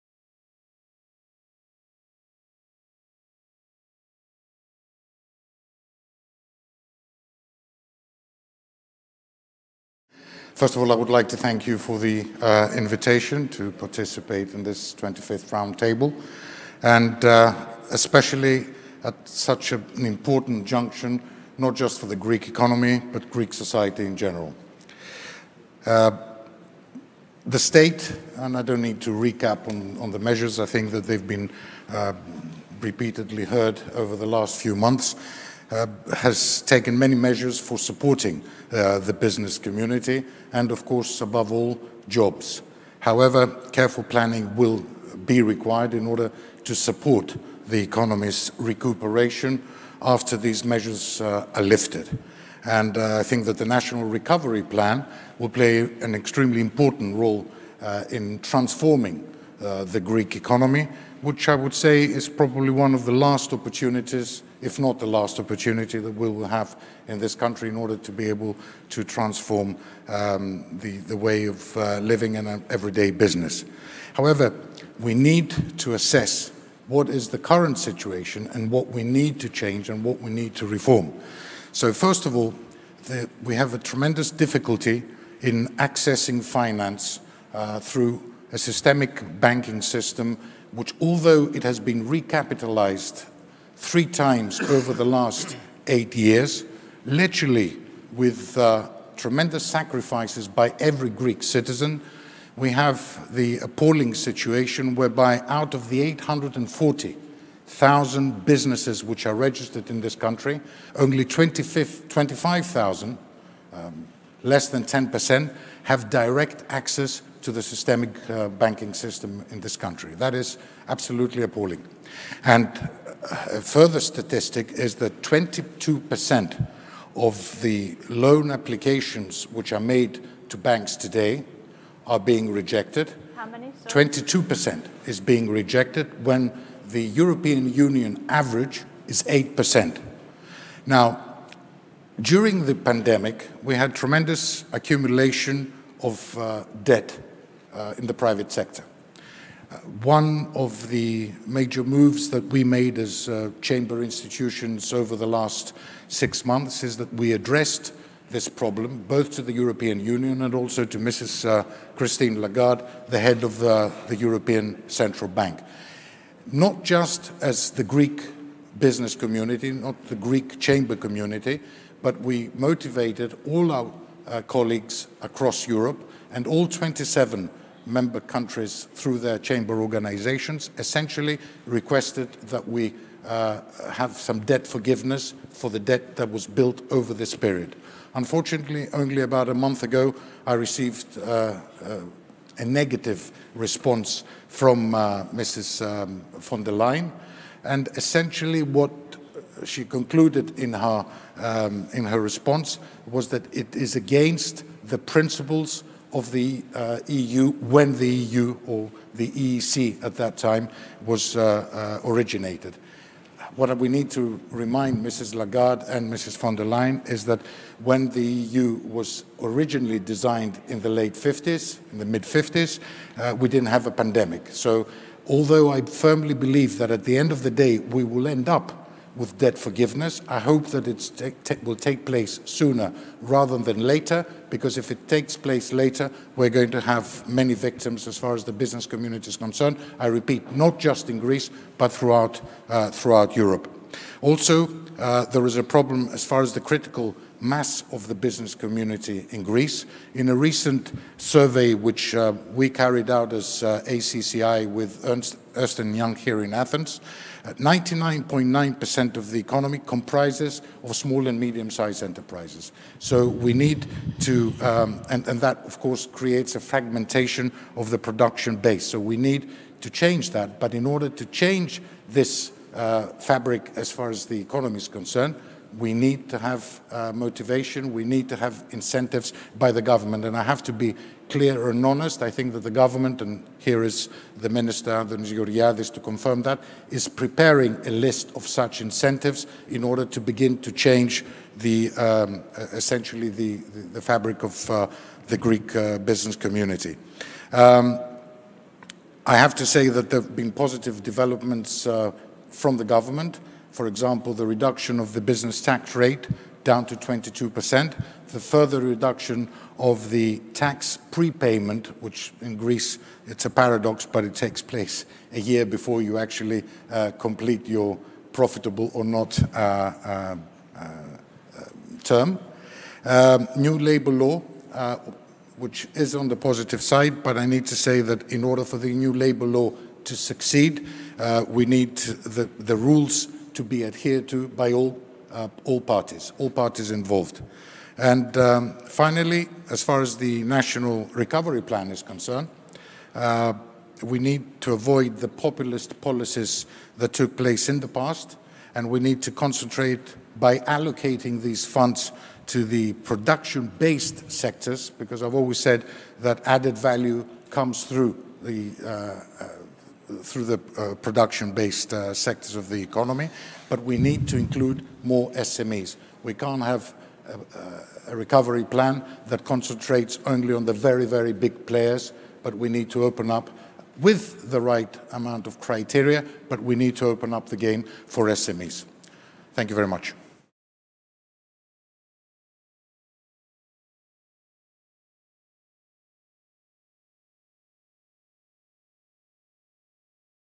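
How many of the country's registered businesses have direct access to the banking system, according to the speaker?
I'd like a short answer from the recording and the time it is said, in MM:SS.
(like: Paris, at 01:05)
25,000, at 01:51.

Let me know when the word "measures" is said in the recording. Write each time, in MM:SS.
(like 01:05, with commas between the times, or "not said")
00:30, 00:37, 00:50.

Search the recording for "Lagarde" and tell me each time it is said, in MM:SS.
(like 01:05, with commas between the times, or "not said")
02:42, 03:35.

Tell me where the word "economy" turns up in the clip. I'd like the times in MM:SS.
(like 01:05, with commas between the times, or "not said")
00:22, 00:47, 01:00, 04:19, 04:34, 06:02.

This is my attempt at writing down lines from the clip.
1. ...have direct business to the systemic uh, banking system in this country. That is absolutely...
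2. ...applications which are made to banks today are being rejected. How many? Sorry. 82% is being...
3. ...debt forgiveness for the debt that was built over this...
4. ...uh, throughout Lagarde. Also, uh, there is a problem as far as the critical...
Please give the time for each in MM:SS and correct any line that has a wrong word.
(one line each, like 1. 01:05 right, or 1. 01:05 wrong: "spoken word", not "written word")
1. 01:55 wrong: "access", not "business"
2. 02:08 wrong: "22", not "82"
3. 03:04 right
4. 04:02 wrong: "Europe", not "Lagarde".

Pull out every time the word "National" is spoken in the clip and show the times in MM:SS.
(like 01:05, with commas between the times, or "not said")
00:53, 05:40.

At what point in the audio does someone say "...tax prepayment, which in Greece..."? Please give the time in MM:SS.
05:10.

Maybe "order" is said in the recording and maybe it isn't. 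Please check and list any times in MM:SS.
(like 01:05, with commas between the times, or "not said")
00:46, 01:07, 04:30, 04:49, 05:28.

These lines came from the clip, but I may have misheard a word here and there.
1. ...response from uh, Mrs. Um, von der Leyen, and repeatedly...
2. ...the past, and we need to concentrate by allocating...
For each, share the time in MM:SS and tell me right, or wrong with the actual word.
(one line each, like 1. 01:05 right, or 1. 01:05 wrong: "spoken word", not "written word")
1. 03:13 wrong: "essentially", not "repeatedly"
2. 05:47 right.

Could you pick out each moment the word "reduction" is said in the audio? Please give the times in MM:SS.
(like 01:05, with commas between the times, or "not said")
05:04, 05:08.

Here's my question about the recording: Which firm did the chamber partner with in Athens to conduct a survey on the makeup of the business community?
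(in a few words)
Ernst & Young.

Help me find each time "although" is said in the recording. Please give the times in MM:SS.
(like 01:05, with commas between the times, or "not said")
01:31, 03:45.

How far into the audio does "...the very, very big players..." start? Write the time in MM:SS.
06:10.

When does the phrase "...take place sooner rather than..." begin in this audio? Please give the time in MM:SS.
03:51.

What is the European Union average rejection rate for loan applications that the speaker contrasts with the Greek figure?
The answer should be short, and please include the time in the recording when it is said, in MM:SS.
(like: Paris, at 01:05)
8%, at 02:19.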